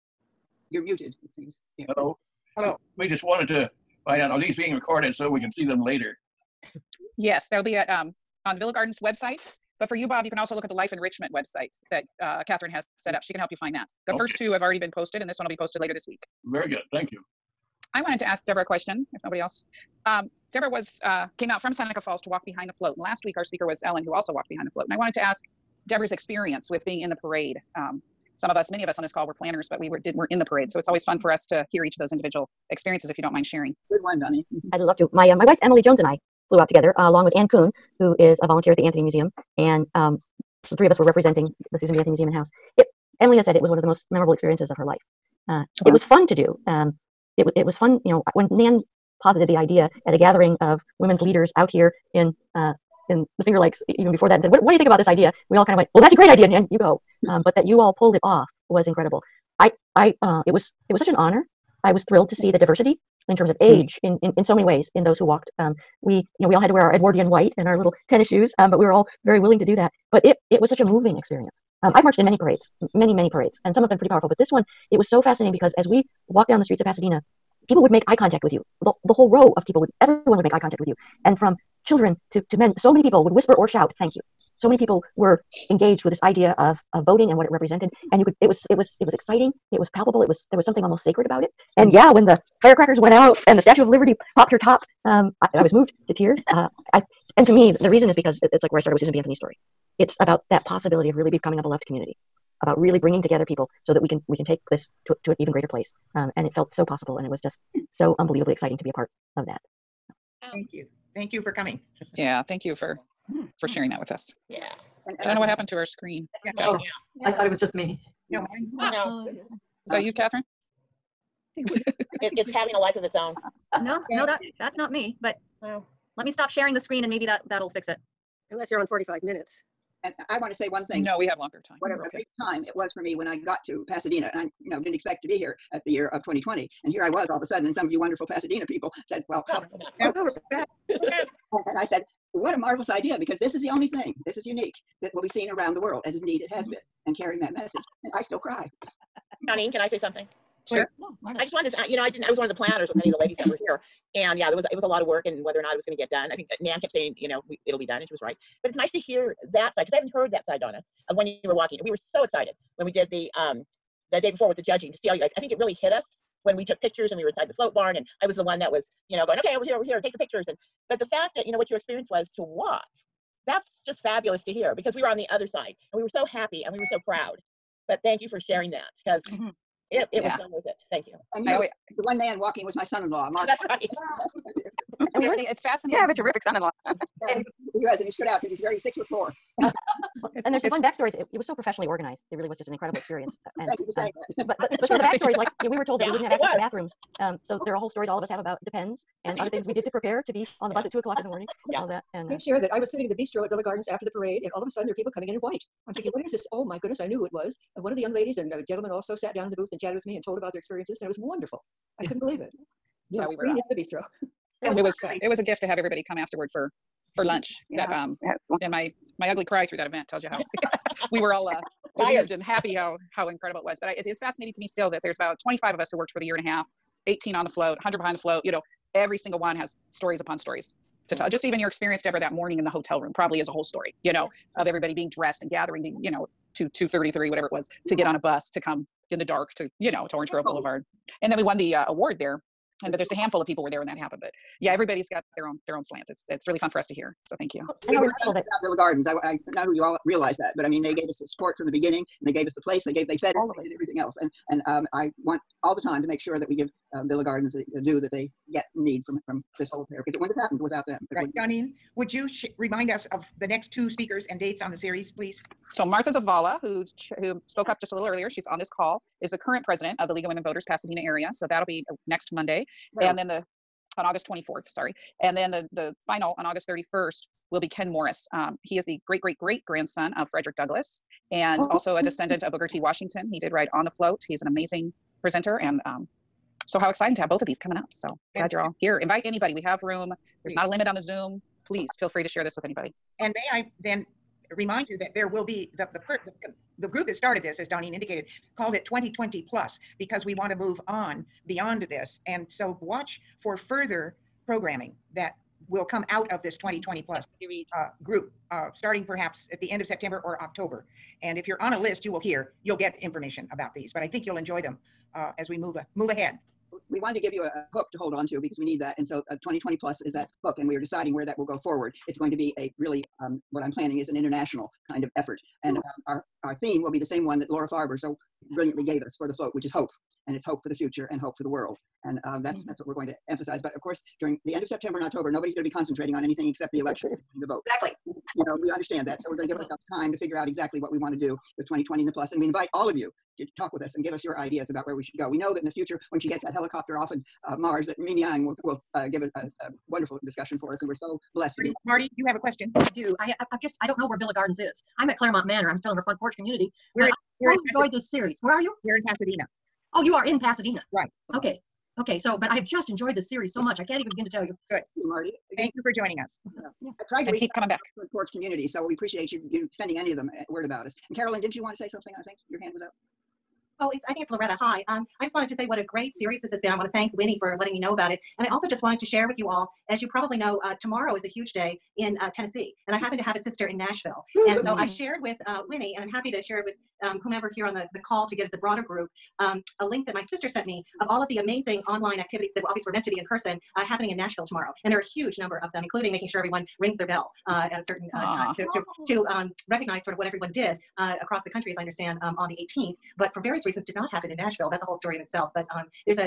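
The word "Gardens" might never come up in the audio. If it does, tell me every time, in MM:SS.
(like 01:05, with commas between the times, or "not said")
00:08, 03:23, 04:08, 04:17, 05:54.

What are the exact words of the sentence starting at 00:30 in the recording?
So it's always fun for us to hear each of those individual experiences.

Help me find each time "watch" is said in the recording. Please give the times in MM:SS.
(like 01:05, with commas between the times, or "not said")
02:52, 05:02.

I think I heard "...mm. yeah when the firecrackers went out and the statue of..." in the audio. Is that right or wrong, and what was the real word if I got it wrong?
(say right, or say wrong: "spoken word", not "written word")
right.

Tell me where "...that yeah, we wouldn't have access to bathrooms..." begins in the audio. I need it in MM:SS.
03:15.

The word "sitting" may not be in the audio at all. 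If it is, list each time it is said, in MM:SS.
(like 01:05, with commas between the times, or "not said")
03:22.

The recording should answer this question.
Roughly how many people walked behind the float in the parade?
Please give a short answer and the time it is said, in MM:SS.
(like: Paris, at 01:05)
100, at 03:47.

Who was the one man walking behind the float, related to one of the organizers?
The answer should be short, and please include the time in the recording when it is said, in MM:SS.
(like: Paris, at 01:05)
Mark, at 03:03.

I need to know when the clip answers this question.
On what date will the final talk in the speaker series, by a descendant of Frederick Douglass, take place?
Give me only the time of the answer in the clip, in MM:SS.
04:36.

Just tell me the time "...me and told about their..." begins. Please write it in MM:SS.
03:30.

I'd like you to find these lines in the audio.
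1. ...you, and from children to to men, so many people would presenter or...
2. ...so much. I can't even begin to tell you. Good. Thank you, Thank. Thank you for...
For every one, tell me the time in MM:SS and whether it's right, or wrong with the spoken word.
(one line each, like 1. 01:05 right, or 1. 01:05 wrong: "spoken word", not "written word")
1. 01:20 wrong: "whisper", not "presenter"
2. 06:03 wrong: "Marty", not "Thank".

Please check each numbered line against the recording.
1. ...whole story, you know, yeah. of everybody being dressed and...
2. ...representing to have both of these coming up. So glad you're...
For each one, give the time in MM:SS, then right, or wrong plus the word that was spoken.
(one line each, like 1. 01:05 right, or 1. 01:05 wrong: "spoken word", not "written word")
1. 03:53 right
2. 04:46 wrong: "exciting", not "representing".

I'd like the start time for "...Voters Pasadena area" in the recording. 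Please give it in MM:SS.
04:30.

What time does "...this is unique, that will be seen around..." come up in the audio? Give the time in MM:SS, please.
02:24.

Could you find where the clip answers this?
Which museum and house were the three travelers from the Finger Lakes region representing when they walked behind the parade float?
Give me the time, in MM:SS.
00:41.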